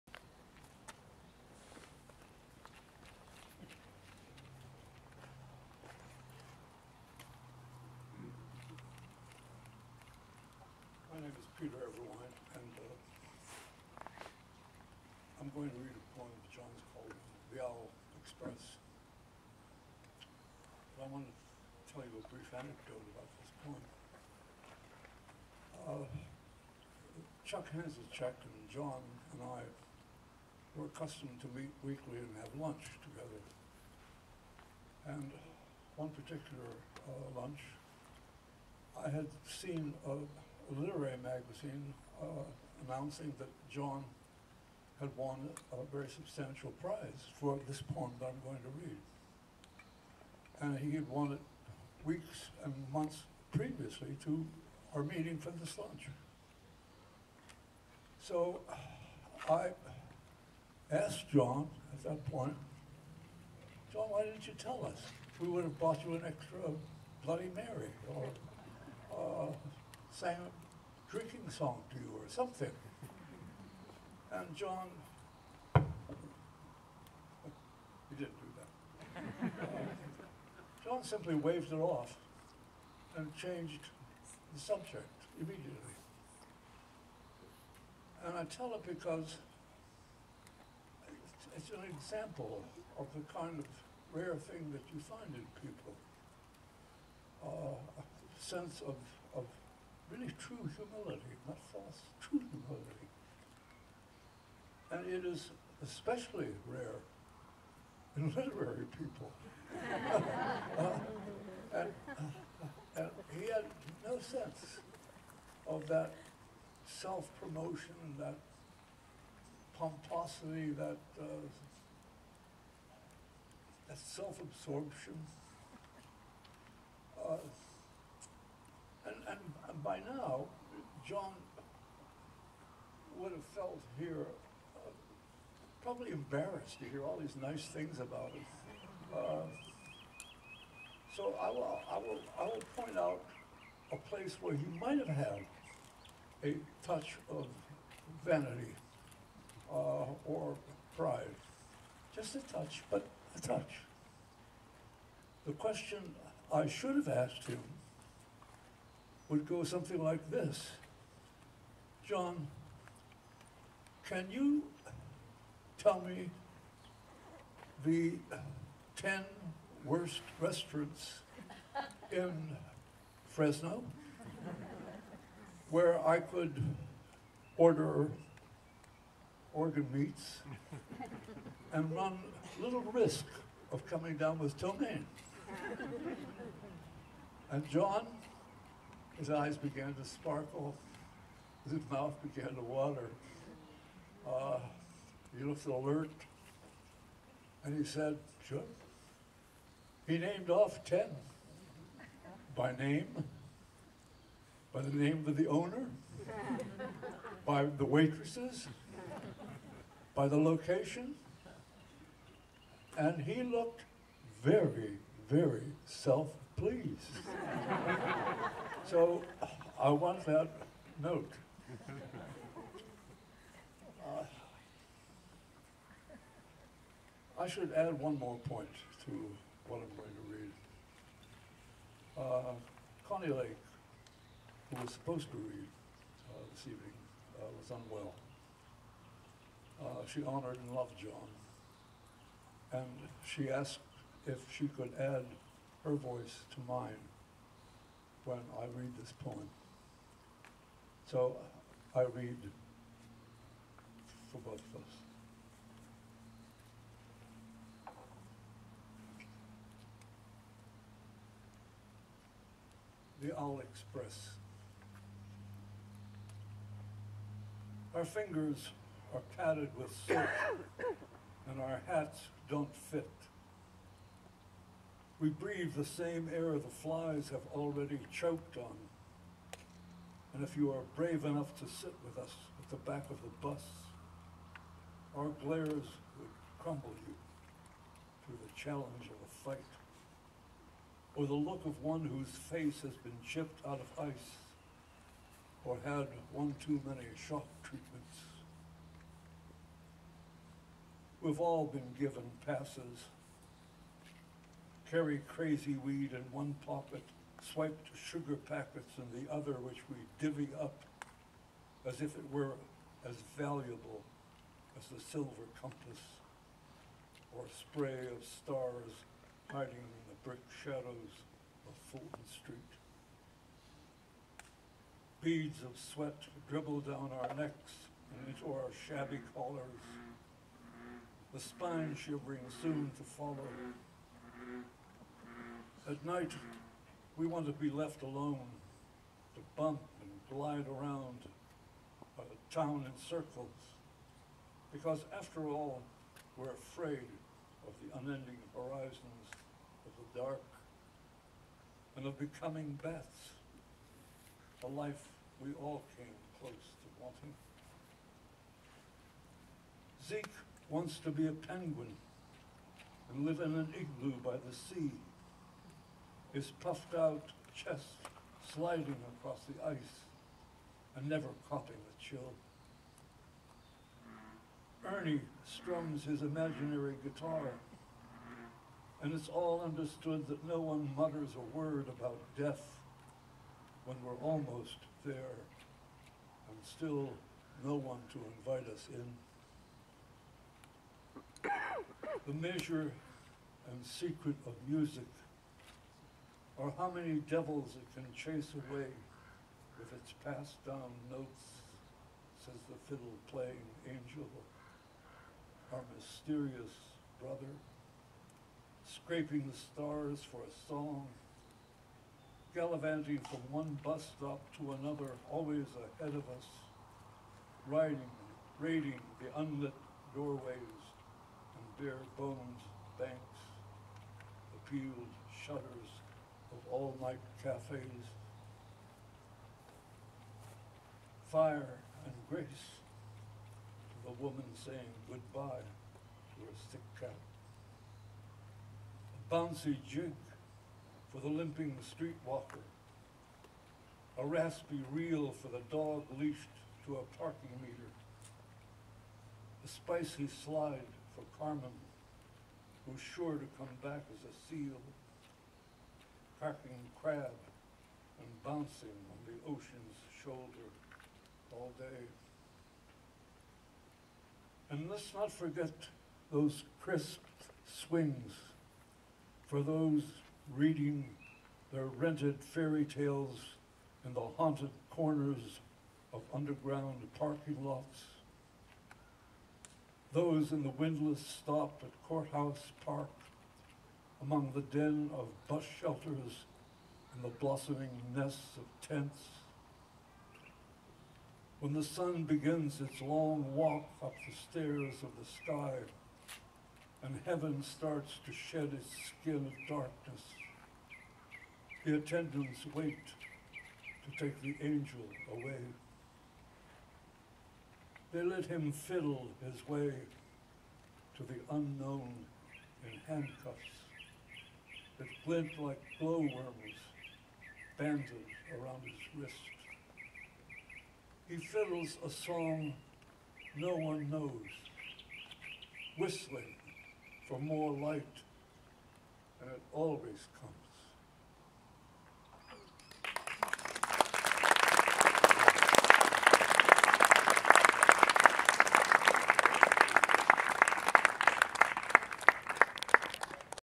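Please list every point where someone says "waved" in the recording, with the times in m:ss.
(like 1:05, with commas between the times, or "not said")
1:21.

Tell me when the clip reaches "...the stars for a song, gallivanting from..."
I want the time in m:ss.
6:49.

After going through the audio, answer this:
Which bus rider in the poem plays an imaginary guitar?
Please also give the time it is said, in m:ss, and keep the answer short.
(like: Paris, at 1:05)
Ernie, at 6:14.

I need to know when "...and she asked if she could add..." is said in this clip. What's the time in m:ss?
4:02.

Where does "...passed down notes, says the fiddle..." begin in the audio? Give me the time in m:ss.
6:40.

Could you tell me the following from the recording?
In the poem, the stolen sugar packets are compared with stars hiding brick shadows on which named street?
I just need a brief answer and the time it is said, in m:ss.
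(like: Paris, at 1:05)
Fulton Street, at 5:21.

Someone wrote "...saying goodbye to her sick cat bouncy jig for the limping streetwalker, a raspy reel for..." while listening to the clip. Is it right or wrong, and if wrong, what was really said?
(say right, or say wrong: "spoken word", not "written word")
right.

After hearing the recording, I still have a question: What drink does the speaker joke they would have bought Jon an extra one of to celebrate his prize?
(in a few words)
Bloody Mary.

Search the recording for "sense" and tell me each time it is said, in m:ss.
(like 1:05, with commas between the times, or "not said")
1:38, 1:54.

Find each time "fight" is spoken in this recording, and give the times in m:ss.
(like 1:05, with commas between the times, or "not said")
4:49.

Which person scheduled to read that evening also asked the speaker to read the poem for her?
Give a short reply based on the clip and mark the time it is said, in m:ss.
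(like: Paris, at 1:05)
Connie Lake, at 3:53.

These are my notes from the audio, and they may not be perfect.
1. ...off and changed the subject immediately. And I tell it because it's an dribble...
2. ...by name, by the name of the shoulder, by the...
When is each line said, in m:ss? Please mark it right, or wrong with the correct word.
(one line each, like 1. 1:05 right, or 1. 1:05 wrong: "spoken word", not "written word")
1. 1:21 wrong: "example", not "dribble"
2. 3:22 wrong: "owner", not "shoulder".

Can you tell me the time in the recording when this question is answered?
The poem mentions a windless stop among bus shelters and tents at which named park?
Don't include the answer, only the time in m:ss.
8:02.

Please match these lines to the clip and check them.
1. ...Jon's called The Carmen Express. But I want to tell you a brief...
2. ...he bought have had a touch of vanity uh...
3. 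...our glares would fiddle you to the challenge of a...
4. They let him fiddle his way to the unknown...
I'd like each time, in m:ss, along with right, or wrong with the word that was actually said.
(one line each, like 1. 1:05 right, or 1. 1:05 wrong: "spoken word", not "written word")
1. 0:16 wrong: "Owl", not "Carmen"
2. 2:24 wrong: "might", not "bought"
3. 4:45 wrong: "crumble", not "fiddle"
4. 8:28 right.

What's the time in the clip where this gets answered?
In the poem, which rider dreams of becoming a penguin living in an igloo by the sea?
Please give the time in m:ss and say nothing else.
6:00.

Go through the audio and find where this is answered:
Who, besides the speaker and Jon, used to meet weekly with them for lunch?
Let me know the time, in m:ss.
0:27.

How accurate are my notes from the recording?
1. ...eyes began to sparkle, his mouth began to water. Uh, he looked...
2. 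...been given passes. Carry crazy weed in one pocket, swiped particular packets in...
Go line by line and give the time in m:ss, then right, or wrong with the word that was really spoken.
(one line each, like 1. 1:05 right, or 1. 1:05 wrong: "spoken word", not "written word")
1. 3:09 right
2. 5:01 wrong: "sugar", not "particular".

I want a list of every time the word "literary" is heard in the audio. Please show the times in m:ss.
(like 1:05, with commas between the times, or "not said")
0:40, 1:48.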